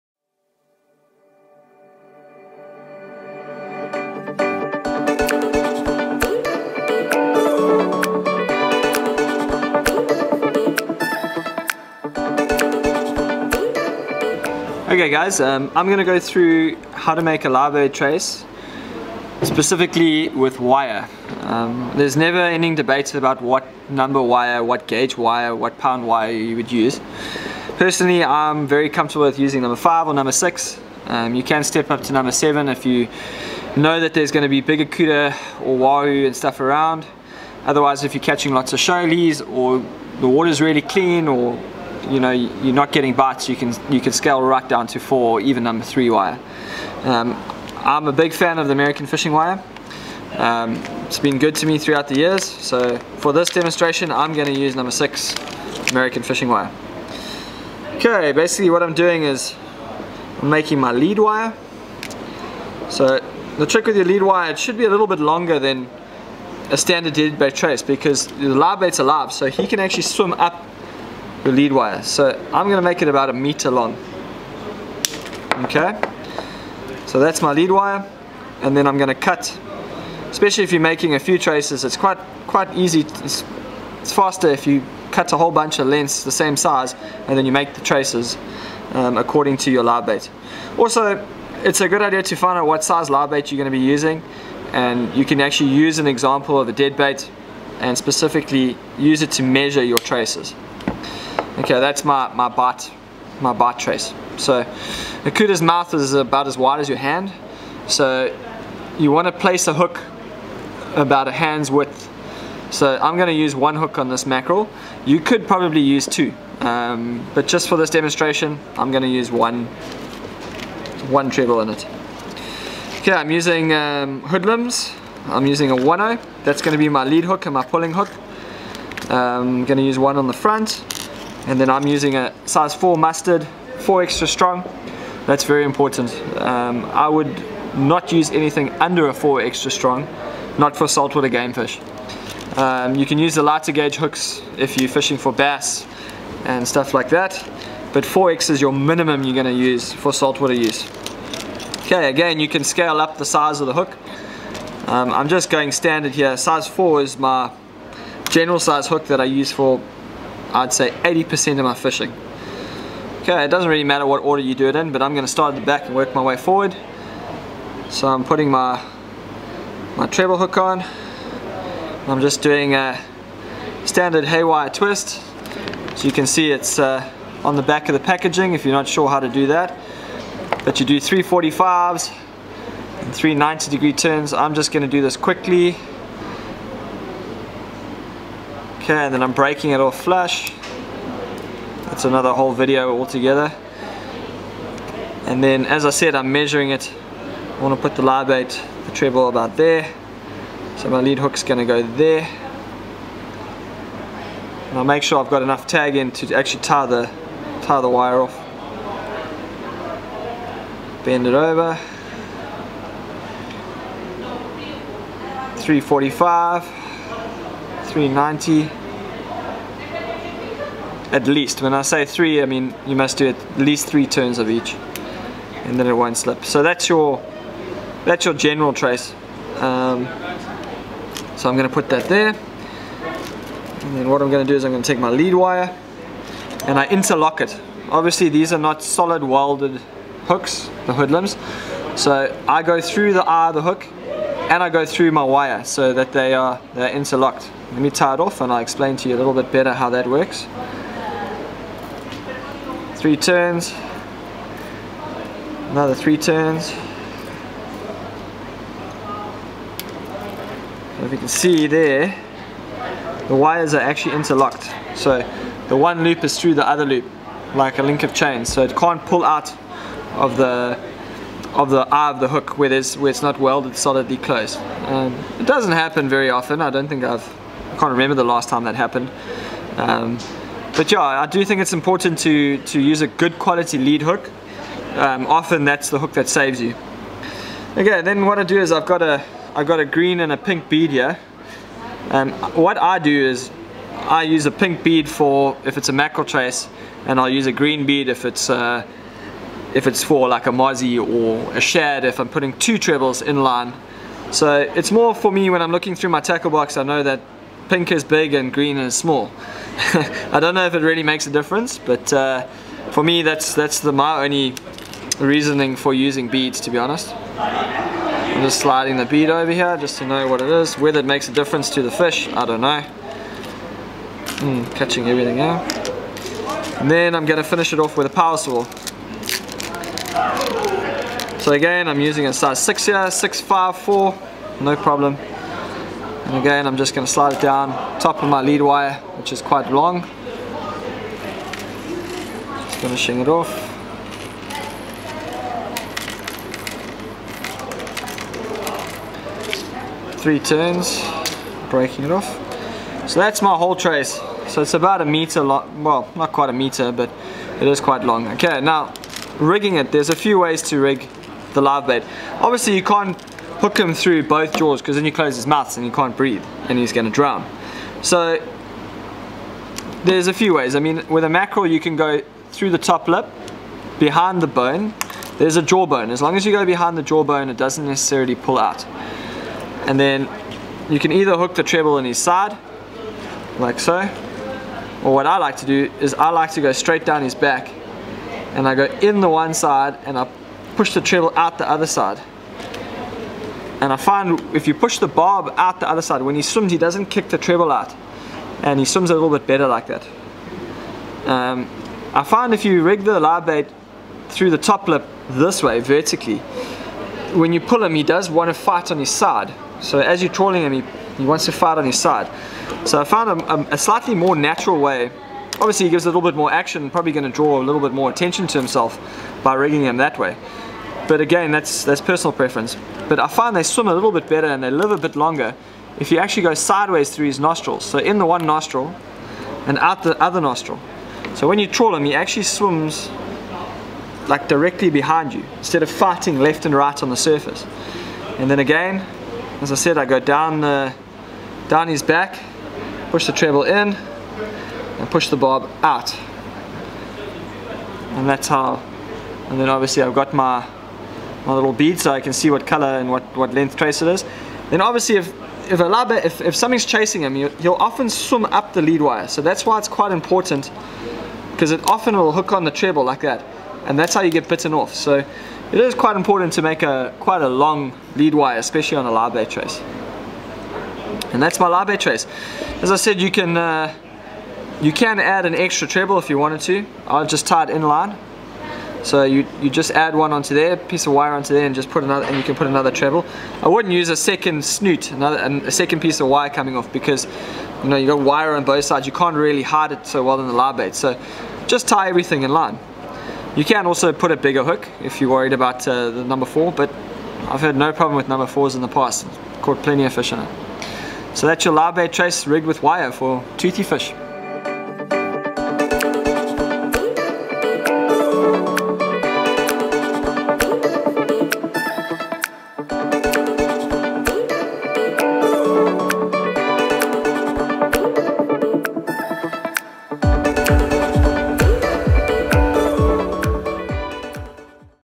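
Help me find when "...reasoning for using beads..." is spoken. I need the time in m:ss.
5:15.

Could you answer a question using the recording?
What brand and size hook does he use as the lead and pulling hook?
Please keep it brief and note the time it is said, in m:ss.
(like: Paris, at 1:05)
Hoodlum 1/0, at 2:04.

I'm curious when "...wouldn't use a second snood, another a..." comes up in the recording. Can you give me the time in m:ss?
8:03.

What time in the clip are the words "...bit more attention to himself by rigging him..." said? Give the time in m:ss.
6:57.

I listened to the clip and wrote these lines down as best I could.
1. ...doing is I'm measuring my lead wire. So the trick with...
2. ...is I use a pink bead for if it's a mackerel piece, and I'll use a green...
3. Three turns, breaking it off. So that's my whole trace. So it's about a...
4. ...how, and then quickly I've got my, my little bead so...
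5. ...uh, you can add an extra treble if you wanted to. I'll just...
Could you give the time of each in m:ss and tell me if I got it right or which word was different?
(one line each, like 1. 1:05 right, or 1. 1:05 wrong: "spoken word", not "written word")
1. 0:58 wrong: "making", not "measuring"
2. 4:53 wrong: "trace", not "piece"
3. 5:50 right
4. 7:28 wrong: "obviously", not "quickly"
5. 7:53 right.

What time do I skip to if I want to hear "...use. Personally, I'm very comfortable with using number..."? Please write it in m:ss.
0:26.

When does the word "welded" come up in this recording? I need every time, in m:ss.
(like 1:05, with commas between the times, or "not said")
3:59, 4:33.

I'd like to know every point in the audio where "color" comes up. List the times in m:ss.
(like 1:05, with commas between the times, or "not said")
7:32.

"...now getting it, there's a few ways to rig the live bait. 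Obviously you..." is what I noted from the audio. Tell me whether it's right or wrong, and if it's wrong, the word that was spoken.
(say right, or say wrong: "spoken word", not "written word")
wrong: "rigging", not "getting".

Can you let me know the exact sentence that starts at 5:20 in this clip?
Whether it makes a difference to the fish, I don't know.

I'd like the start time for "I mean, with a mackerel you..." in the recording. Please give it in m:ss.
6:10.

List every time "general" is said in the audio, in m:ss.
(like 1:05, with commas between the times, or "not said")
2:38, 3:48.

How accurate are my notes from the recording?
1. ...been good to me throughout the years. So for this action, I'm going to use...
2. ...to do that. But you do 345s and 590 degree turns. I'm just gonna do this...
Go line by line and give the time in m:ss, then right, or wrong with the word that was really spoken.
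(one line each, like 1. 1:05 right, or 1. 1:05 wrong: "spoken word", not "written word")
1. 0:51 wrong: "demonstration", not "action"
2. 2:59 wrong: "390", not "590".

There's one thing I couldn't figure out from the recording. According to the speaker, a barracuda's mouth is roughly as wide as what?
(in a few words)
your hand.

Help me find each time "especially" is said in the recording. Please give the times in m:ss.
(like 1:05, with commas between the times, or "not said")
1:20, 7:48.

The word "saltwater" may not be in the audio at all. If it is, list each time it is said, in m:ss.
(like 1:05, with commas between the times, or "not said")
2:20, 2:30.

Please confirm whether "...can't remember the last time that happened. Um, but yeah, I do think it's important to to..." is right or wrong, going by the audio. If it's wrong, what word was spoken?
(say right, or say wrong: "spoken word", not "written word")
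right.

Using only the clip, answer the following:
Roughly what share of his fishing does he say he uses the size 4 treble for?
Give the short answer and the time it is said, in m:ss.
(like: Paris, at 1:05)
80%, at 2:40.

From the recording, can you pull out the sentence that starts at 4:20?
So if you can see there, the wires are actually interlocked.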